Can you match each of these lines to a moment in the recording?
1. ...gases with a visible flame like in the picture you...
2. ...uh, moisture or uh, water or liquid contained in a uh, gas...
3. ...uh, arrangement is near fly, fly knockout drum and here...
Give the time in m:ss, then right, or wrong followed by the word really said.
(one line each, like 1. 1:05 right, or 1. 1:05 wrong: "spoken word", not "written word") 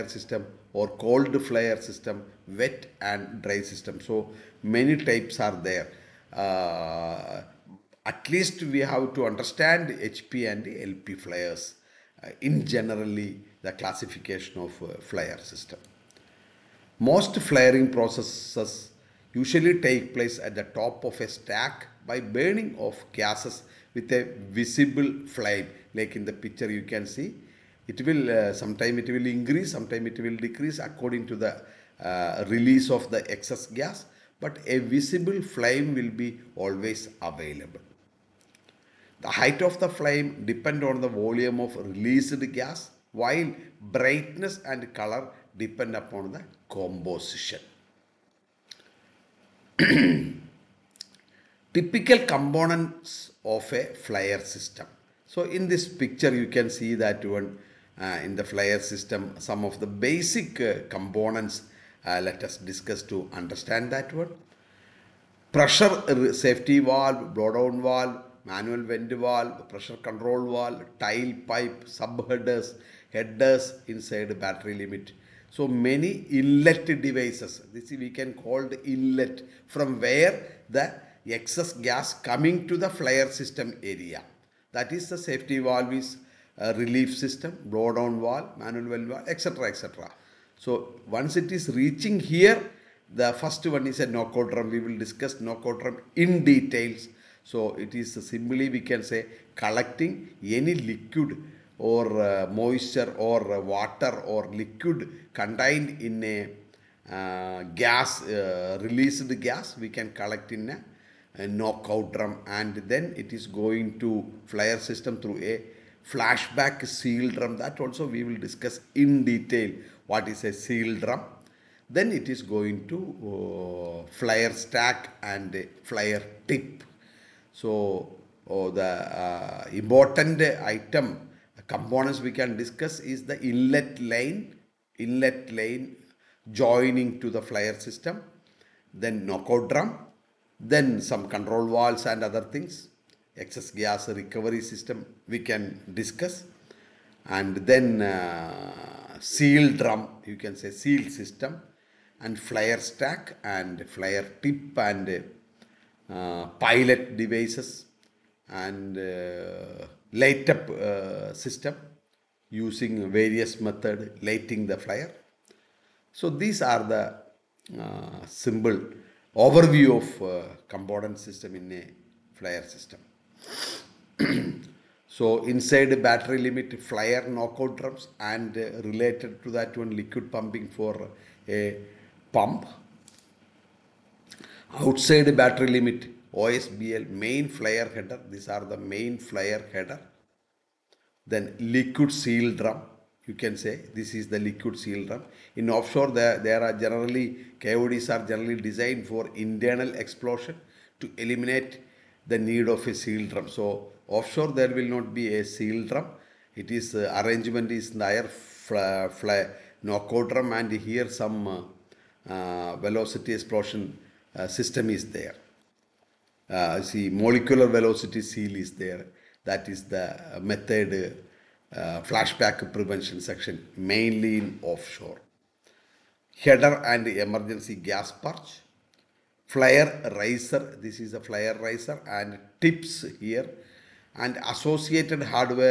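1. 0:23 right
2. 1:42 right
3. 3:26 right.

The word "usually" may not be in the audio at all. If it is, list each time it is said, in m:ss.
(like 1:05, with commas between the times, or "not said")
0:19.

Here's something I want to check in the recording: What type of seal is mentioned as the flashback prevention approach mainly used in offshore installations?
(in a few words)
Molecular velocity seal.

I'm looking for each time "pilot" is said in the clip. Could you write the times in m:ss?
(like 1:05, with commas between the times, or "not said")
2:36.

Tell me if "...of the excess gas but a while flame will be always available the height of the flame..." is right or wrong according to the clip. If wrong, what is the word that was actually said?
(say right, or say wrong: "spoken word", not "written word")
wrong: "visible", not "while".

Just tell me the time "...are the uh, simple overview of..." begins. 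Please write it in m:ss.
2:46.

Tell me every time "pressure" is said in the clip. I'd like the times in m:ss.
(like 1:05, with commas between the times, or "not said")
1:05, 1:09.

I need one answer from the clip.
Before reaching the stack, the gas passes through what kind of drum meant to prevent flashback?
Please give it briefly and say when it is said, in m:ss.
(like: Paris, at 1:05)
Flashback seal drum, at 1:56.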